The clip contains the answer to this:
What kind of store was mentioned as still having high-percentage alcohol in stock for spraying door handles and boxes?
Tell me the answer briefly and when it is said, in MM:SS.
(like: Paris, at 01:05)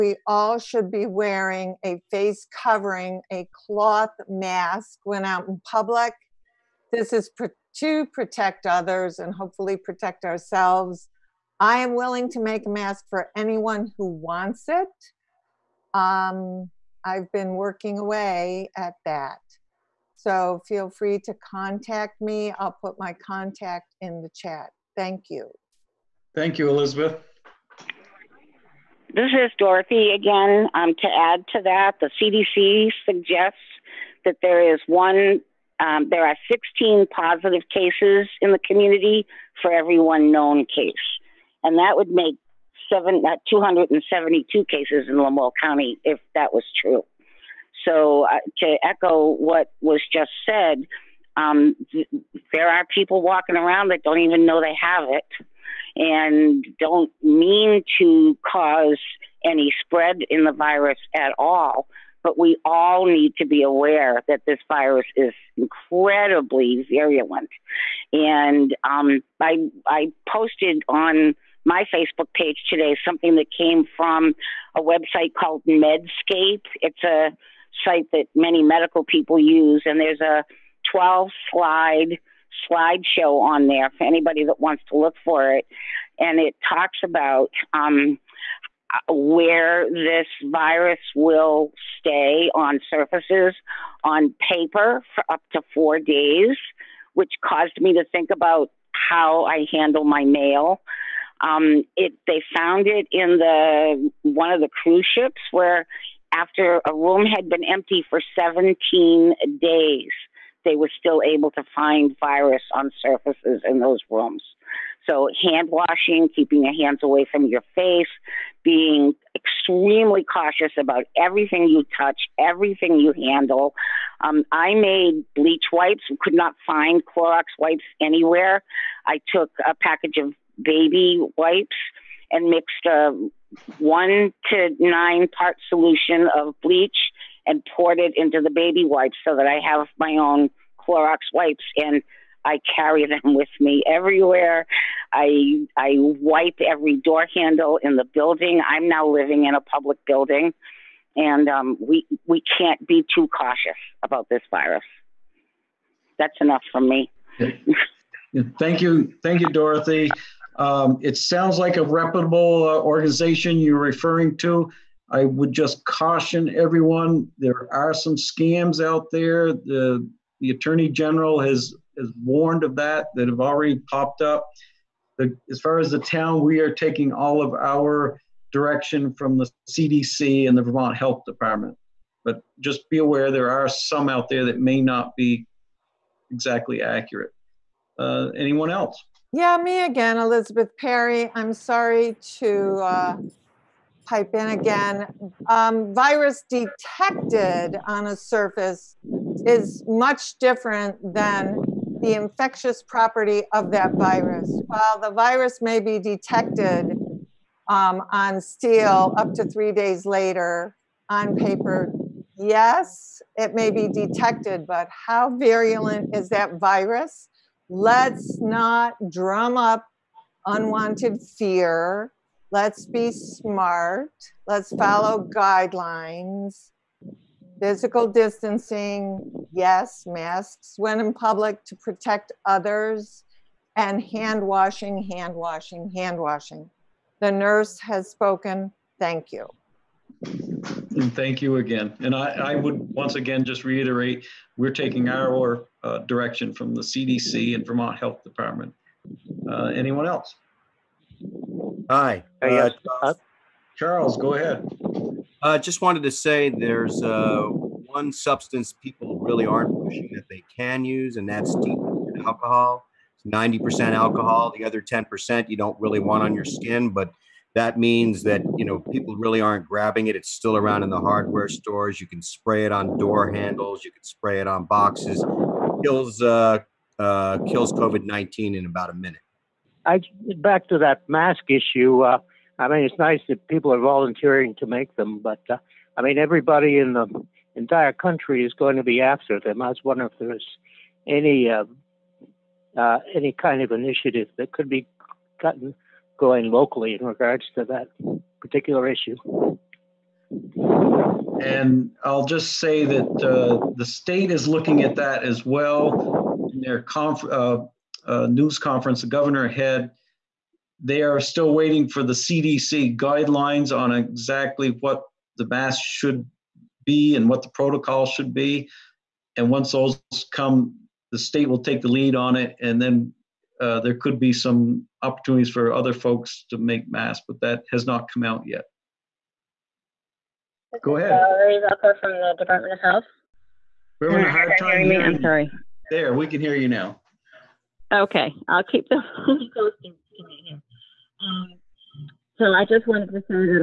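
hardware stores, at 04:30.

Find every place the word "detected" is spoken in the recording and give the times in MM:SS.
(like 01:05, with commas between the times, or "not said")
03:16, 03:25, 03:33.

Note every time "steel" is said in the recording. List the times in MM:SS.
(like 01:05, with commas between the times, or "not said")
03:28.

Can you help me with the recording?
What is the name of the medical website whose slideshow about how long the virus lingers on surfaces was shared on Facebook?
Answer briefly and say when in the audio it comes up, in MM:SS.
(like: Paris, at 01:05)
Medscape, at 01:15.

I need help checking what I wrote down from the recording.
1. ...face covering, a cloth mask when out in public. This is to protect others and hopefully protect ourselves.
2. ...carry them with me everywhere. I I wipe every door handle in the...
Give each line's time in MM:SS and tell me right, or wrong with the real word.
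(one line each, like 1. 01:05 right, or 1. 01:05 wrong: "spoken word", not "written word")
1. 00:02 right
2. 02:22 right.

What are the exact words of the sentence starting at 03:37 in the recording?
Let's not drum up unwanted fear.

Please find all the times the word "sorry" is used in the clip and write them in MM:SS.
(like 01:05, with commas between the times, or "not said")
03:11, 05:35.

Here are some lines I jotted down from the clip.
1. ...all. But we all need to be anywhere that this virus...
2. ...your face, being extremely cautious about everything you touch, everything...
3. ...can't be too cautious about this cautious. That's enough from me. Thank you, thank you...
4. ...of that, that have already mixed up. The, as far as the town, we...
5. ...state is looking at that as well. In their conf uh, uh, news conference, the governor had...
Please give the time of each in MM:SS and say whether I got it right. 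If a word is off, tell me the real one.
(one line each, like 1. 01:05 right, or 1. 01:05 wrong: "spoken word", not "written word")
1. 01:01 wrong: "aware", not "anywhere"
2. 01:57 right
3. 02:32 wrong: "virus", not "cautious"
4. 02:52 wrong: "popped", not "mixed"
5. 05:03 right.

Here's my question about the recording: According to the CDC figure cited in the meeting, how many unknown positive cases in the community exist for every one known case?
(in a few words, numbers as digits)
16.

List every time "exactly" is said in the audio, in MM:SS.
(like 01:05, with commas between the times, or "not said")
03:06, 05:13.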